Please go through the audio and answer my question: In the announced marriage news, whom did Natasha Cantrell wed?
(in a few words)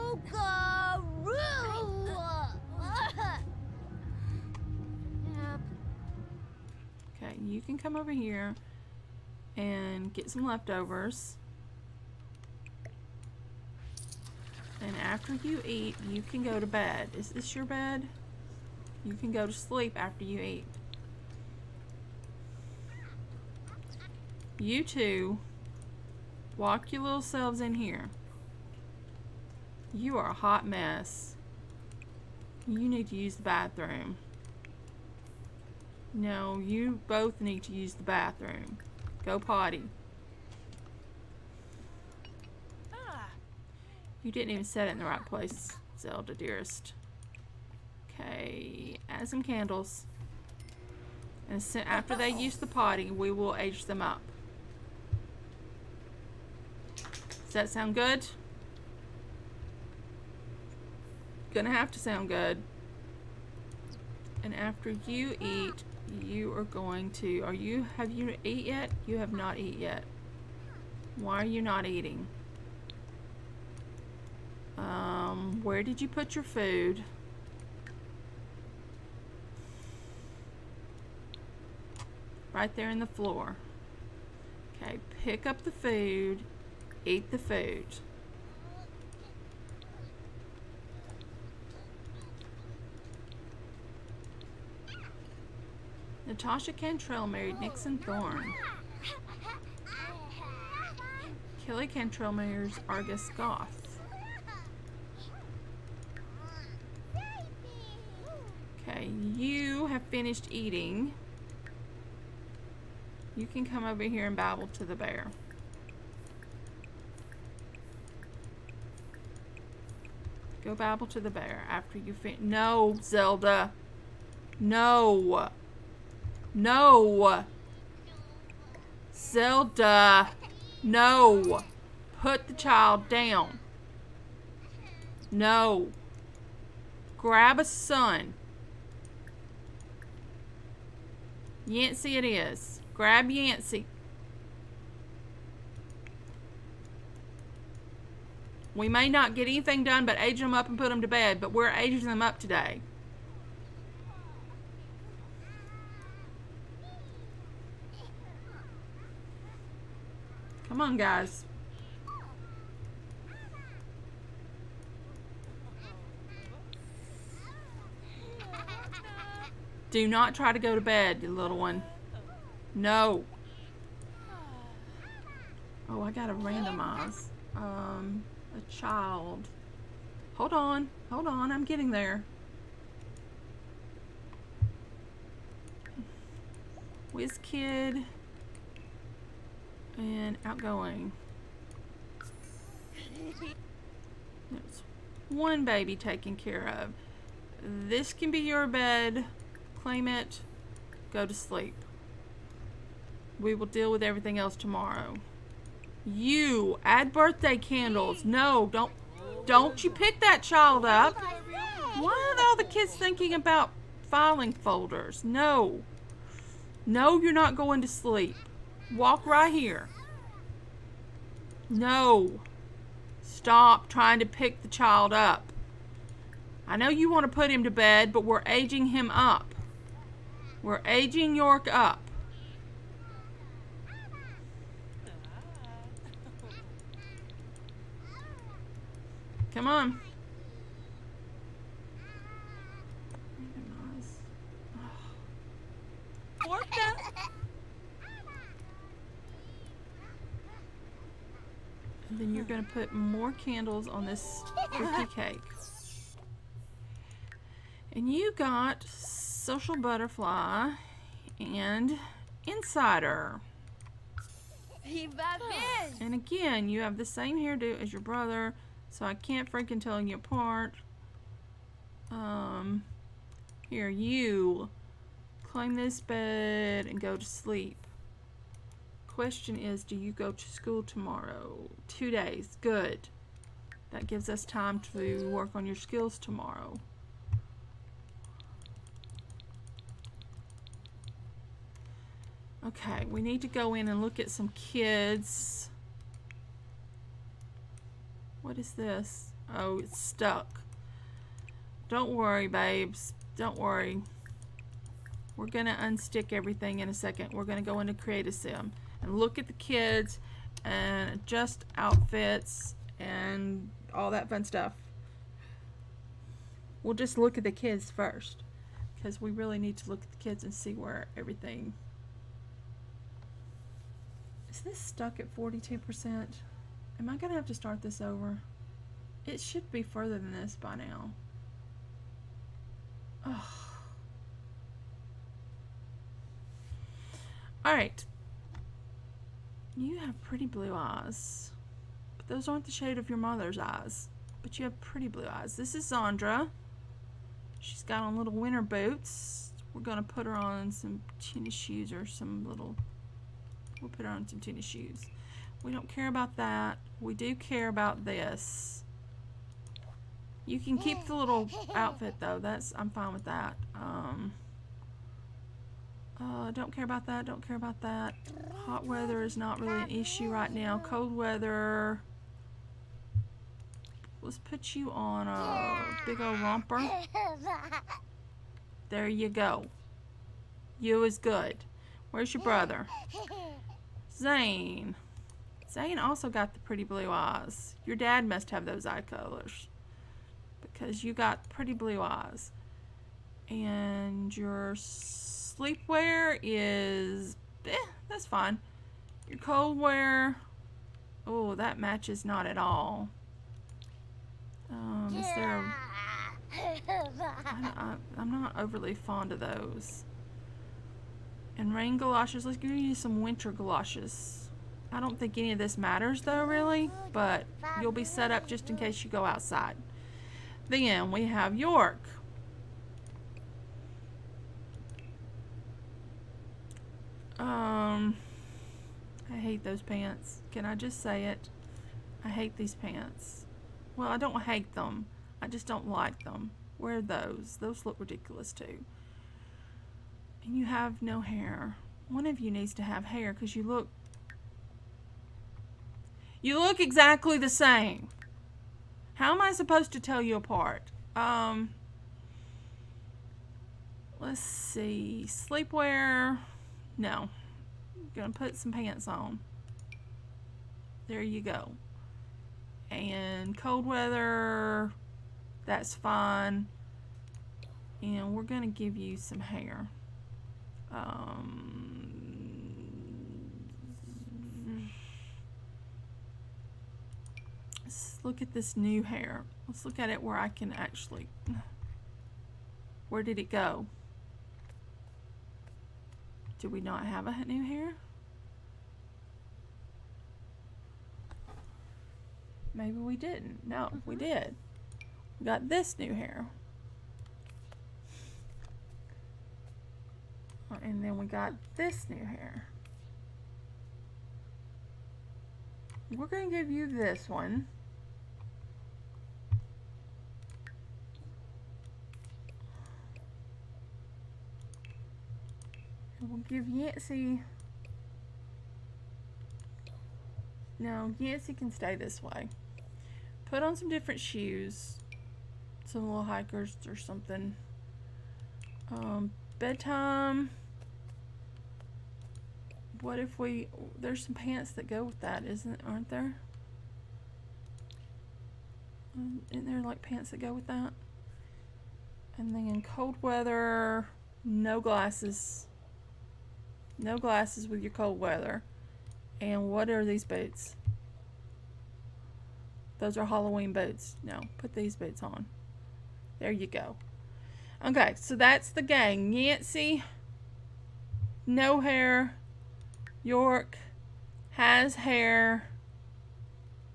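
Nixon Thorne.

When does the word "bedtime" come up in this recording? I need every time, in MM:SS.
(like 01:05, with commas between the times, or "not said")
08:49.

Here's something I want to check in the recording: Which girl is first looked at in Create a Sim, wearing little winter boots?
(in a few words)
Zandra.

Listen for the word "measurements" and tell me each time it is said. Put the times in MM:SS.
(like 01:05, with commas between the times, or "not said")
not said.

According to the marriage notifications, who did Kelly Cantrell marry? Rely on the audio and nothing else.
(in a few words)
Argus Goth.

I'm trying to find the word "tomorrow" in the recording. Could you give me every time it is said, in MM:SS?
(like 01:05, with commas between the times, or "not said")
03:24, 04:40, 04:46.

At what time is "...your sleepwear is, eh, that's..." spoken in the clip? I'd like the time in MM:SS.
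06:34.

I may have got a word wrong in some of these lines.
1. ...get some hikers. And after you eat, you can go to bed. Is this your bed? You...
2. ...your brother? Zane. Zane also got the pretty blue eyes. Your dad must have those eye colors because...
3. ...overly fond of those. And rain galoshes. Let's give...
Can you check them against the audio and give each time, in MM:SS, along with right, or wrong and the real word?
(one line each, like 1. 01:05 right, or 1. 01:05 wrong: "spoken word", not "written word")
1. 00:10 wrong: "leftovers", not "hikers"
2. 06:22 right
3. 06:48 right.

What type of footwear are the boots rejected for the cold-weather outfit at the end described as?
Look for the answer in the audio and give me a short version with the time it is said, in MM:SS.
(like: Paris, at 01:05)
Halloween boots, at 09:13.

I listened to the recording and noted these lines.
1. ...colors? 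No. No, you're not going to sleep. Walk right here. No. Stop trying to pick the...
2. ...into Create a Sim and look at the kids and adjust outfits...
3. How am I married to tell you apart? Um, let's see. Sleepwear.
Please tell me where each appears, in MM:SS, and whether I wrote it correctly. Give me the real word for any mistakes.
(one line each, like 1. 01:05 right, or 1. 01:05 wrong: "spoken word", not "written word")
1. 03:34 wrong: "folders", not "colors"
2. 05:07 right
3. 07:29 wrong: "supposed", not "married".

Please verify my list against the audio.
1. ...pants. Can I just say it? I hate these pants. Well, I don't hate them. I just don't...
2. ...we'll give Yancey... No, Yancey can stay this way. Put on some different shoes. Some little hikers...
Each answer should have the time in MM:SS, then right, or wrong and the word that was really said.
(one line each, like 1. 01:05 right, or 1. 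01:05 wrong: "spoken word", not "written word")
1. 07:09 right
2. 08:36 right.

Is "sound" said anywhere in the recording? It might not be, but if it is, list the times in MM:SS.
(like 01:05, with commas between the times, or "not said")
00:57, 01:01.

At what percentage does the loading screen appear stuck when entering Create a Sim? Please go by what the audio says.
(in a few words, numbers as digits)
42%.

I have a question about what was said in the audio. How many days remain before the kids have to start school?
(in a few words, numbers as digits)
2.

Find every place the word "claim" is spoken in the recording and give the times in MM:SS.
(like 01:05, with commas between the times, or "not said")
03:19, 04:35.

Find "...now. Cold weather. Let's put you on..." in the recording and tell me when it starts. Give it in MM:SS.
06:10.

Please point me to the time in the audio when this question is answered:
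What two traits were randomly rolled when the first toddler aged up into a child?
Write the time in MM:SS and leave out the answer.
03:07.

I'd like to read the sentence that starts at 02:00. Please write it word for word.
Go babble to the bear after you fin- No, Zelda!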